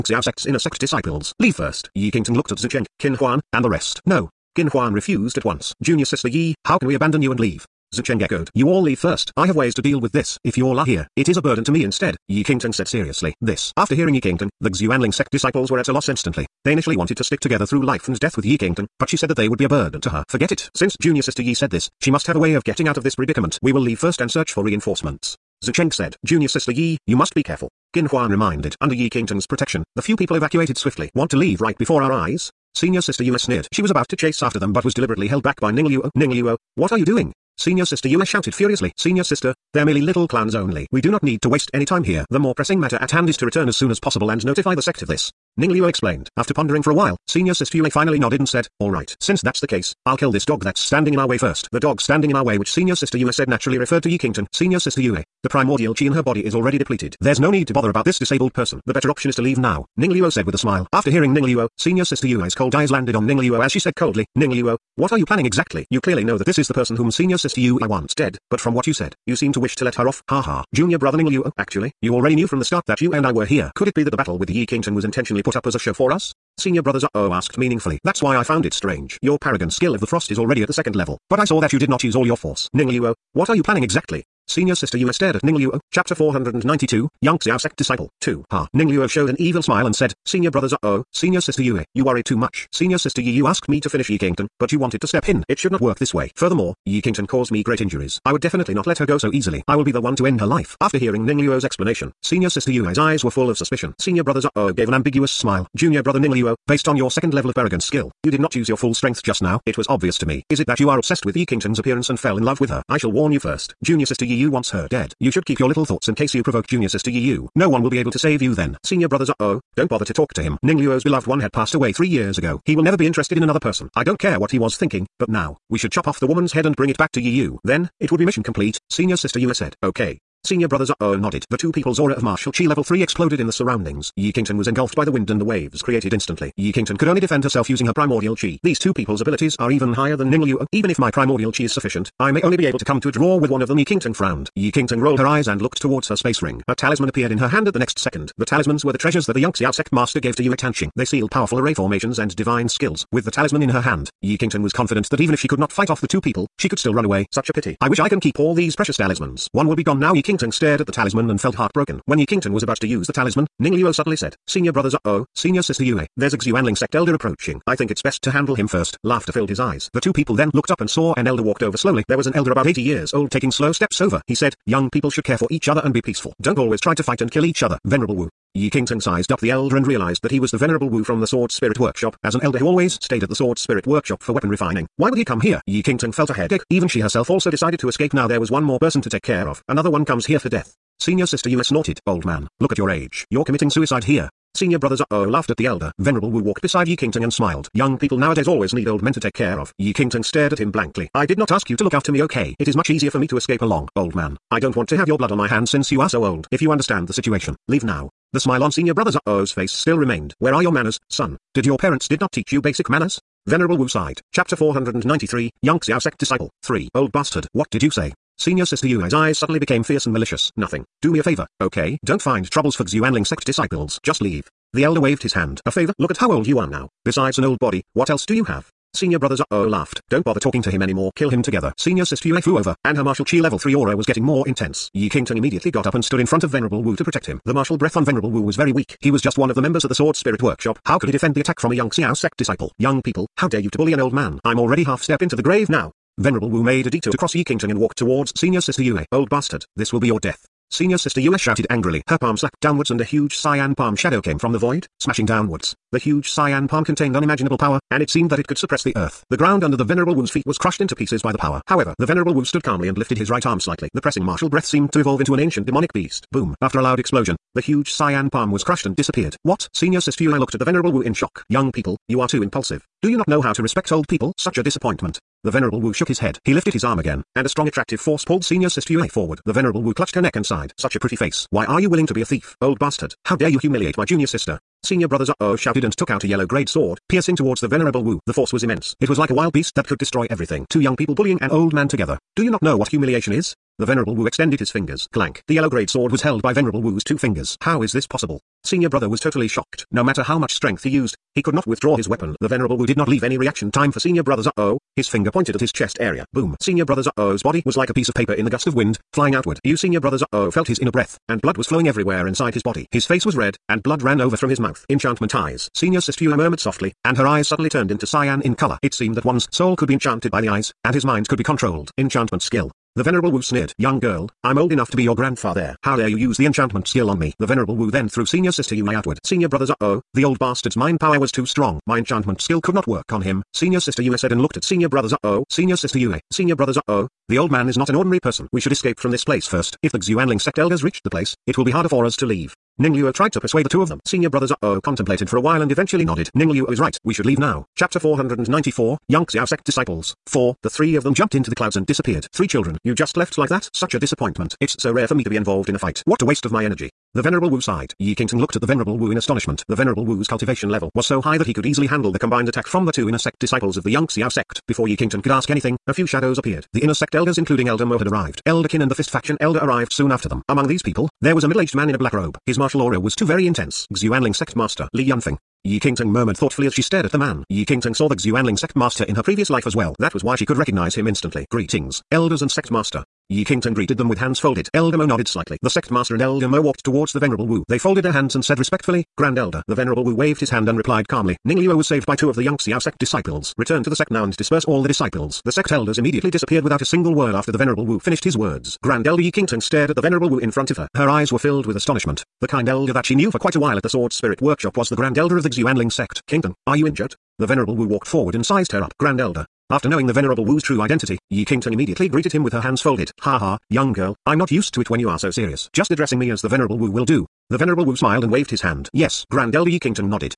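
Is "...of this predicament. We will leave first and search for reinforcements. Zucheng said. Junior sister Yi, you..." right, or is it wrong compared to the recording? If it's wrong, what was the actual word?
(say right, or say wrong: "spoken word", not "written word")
right.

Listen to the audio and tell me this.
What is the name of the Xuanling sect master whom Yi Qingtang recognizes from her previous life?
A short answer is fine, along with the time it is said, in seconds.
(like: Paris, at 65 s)
Li Yunfeng, at 374 s.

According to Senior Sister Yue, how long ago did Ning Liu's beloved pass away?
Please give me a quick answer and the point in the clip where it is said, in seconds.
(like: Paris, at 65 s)
3 years ago, at 121 s.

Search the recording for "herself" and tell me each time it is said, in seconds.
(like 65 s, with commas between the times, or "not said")
137 s, 187 s.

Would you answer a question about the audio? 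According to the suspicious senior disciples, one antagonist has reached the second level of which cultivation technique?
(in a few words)
Paragon skill of the Frost.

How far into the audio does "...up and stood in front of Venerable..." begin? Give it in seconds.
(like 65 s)
235 s.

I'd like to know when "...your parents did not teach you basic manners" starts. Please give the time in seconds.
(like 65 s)
211 s.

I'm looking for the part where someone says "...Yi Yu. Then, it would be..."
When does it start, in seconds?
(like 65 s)
127 s.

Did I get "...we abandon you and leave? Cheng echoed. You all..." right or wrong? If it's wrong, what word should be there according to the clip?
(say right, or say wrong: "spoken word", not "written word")
right.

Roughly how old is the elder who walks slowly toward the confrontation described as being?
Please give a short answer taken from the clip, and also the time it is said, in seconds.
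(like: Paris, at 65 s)
80, at 172 s.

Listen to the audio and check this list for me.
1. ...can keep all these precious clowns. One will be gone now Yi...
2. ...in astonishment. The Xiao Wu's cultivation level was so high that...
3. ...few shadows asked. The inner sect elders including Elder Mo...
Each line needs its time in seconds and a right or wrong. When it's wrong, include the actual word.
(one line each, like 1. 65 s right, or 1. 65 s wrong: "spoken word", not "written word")
1. 158 s wrong: "talismans", not "clowns"
2. 359 s wrong: "Venerable", not "Xiao"
3. 365 s wrong: "appeared", not "asked".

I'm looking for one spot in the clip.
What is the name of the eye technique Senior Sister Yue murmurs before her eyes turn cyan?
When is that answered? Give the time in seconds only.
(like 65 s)
314 s.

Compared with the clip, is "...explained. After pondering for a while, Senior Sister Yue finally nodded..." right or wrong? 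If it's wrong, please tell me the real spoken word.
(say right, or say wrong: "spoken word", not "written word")
right.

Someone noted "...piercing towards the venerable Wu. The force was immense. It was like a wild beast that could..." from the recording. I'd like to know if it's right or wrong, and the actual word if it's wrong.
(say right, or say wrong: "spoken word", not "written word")
right.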